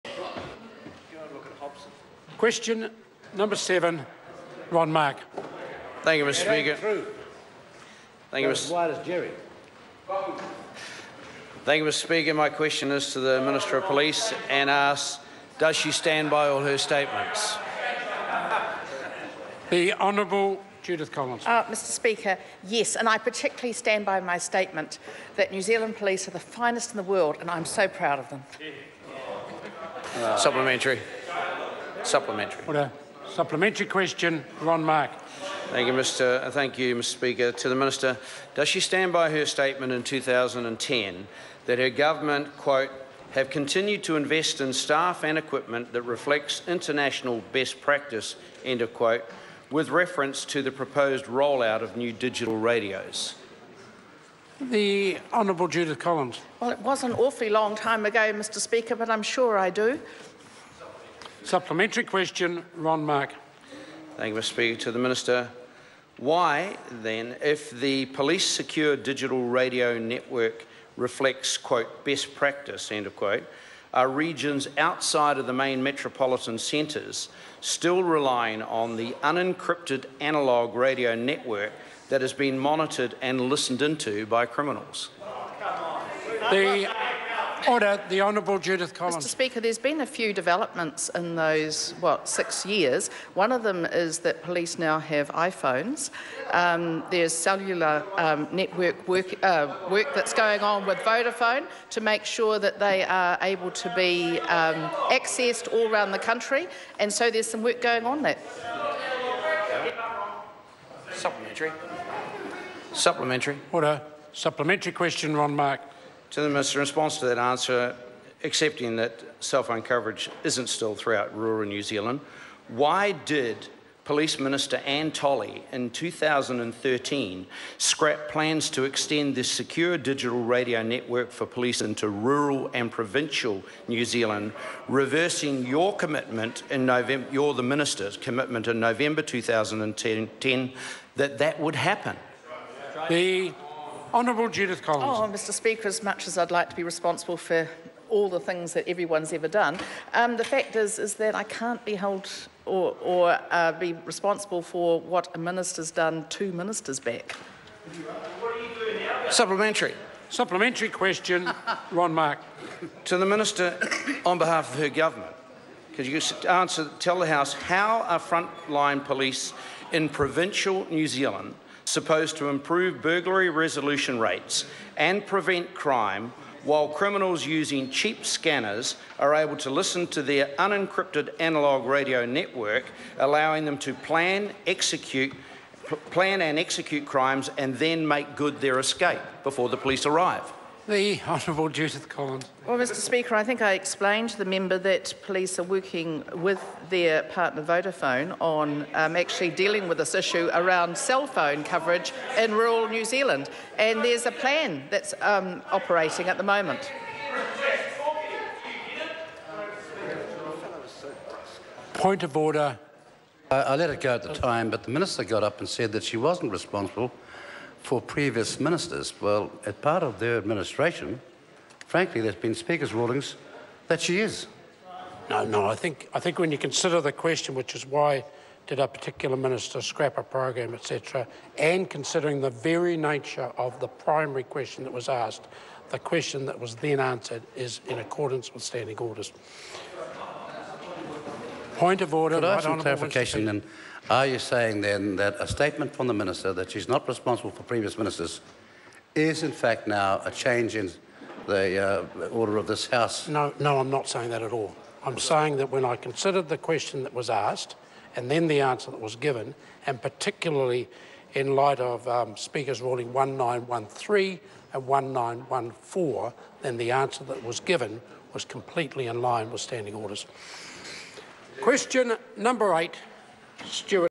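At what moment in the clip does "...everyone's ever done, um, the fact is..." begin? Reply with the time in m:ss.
2:28.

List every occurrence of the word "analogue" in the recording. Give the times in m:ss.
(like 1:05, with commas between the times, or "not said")
1:20, 3:01.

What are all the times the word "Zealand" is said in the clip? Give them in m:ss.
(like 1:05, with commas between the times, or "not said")
0:25, 2:01, 2:14, 2:51, 3:23.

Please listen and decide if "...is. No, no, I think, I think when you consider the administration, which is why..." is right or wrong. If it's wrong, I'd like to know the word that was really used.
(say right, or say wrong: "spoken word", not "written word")
wrong: "question", not "administration".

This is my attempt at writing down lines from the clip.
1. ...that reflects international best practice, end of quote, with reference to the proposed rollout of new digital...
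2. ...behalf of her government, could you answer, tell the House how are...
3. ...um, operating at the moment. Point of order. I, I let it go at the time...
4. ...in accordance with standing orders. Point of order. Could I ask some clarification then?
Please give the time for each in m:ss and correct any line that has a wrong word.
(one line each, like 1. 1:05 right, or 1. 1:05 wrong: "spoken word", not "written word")
1. 0:45 right
2. 2:44 right
3. 3:25 right
4. 3:57 right.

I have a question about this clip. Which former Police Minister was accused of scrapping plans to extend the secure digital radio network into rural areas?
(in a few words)
Anne Tolley.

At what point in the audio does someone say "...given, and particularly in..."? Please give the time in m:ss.
4:19.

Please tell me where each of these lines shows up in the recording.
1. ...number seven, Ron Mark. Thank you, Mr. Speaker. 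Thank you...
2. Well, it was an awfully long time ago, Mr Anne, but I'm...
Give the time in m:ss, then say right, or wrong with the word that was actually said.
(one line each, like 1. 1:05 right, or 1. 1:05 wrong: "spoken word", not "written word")
1. 0:03 right
2. 0:56 wrong: "Speaker", not "Anne".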